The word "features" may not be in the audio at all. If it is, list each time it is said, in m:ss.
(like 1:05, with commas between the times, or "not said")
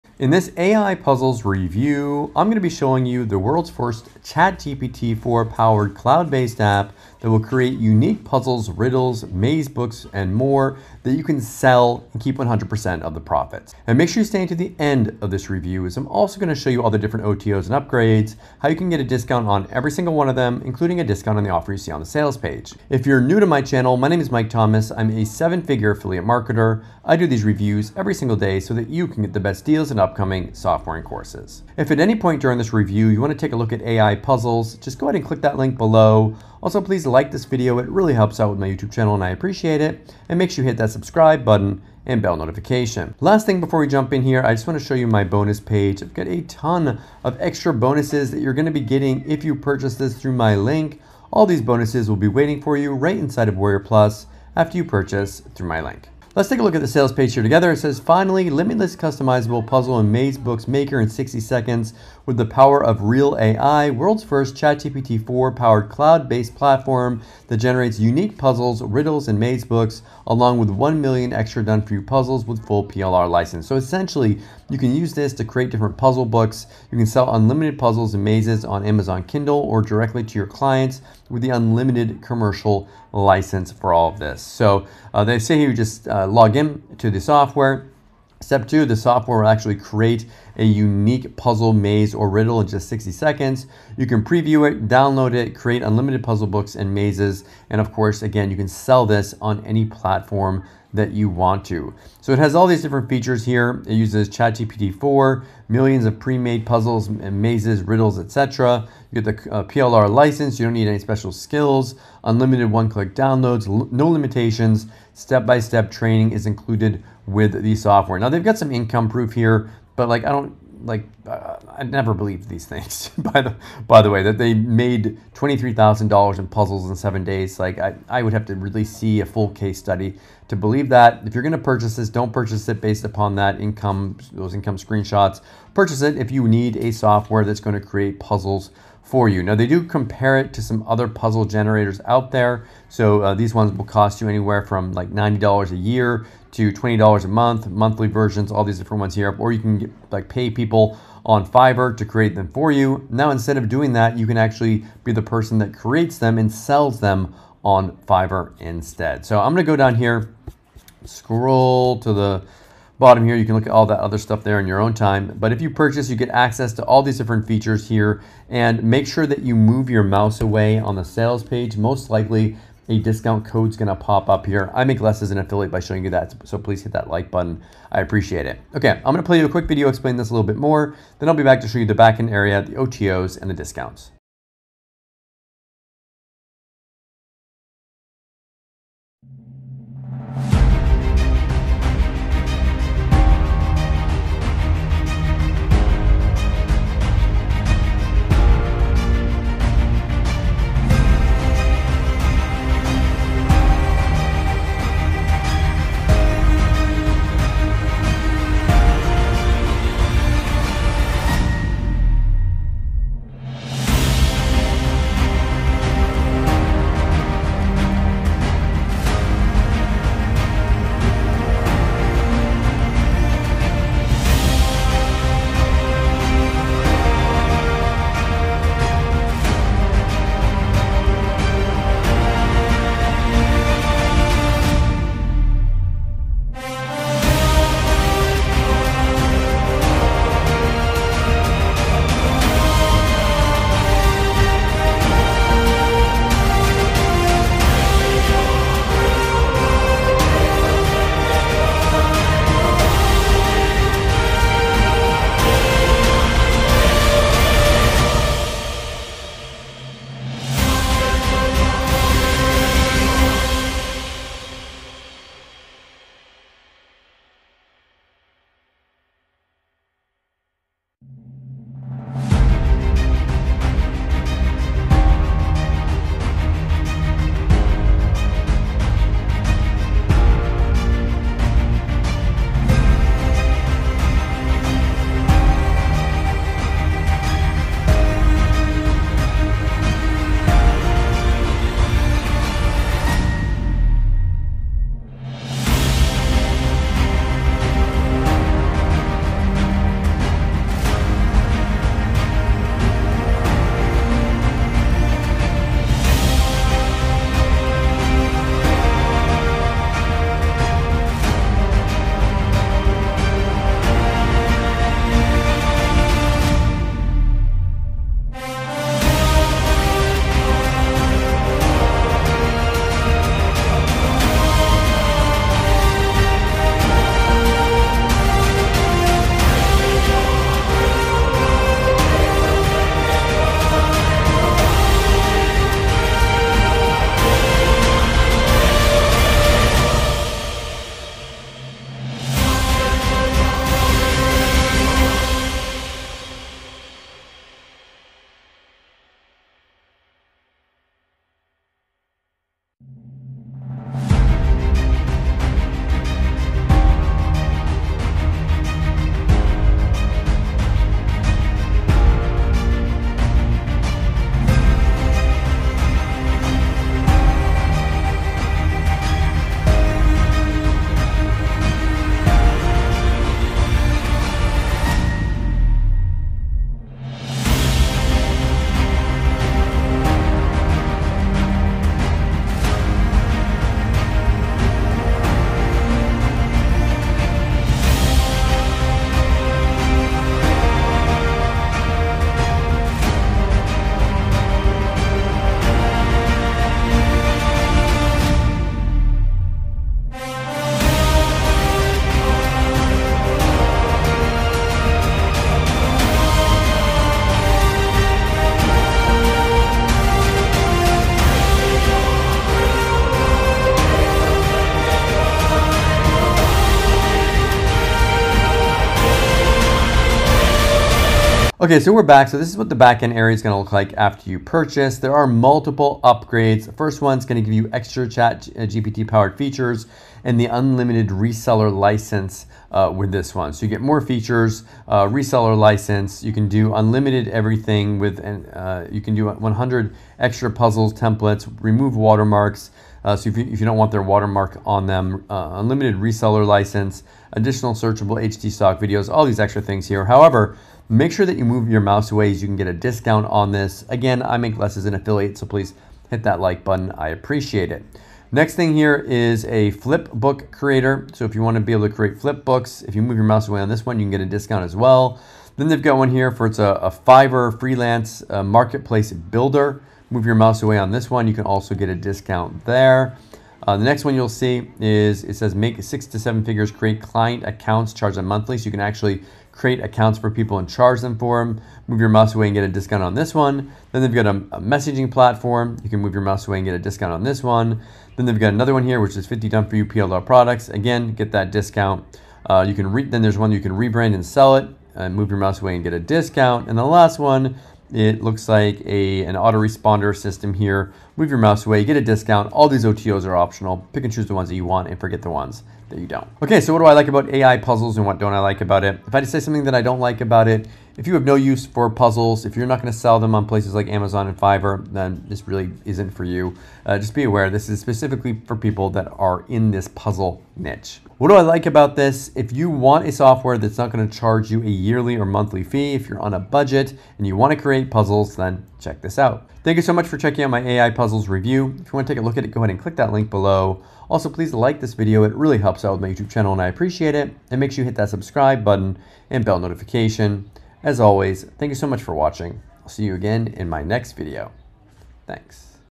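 1:43, 2:47, 7:09, 7:14.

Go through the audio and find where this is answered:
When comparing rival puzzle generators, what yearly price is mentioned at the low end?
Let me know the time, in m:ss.
2:25.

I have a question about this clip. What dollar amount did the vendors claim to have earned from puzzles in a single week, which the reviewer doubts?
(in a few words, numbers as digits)
$23,000.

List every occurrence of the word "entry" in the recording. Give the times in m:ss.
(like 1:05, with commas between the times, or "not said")
not said.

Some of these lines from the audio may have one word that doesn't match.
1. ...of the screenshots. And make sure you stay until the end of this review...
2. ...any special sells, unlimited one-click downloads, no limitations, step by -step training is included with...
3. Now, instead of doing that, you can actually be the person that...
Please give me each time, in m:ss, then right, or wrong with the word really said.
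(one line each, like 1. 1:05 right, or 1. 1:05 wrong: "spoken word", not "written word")
1. 0:13 wrong: "profits", not "screenshots"
2. 1:50 wrong: "skills", not "sells"
3. 2:33 right.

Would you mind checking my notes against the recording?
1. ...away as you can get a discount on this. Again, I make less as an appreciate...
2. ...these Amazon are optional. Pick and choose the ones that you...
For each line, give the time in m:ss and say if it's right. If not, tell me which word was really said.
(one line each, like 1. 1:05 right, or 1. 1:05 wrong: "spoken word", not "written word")
1. 7:32 wrong: "affiliate", not "appreciate"
2. 8:22 wrong: "OTOs", not "Amazon".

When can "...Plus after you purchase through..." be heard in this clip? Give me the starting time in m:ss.
0:53.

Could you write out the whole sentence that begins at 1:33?
You can preview it, download it, create unlimited puzzle books and mazes.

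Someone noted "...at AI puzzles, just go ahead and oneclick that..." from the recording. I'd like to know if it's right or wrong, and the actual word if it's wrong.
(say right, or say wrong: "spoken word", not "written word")
wrong: "click", not "oneclick".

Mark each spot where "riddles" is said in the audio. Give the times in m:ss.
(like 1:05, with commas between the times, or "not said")
0:08, 1:08, 1:32, 1:47.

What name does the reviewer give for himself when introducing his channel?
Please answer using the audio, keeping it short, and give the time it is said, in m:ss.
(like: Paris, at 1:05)
Mike Thomas, at 0:24.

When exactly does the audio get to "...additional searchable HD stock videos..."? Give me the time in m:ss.
7:27.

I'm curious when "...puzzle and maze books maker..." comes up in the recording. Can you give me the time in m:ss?
0:59.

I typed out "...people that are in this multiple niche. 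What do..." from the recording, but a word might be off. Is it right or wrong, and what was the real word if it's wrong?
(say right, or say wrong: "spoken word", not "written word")
wrong: "puzzle", not "multiple".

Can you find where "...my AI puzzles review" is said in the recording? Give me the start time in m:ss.
8:50.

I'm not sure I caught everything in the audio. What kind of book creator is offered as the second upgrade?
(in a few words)
flip book.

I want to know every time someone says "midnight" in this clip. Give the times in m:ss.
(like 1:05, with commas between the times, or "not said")
not said.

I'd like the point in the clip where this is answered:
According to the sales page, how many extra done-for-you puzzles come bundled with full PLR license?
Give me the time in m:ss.
1:10.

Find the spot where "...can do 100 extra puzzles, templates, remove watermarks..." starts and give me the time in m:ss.
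7:18.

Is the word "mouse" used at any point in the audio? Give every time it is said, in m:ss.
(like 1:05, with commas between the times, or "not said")
2:50, 7:31, 7:43, 7:50, 8:02, 8:06, 8:15, 8:21.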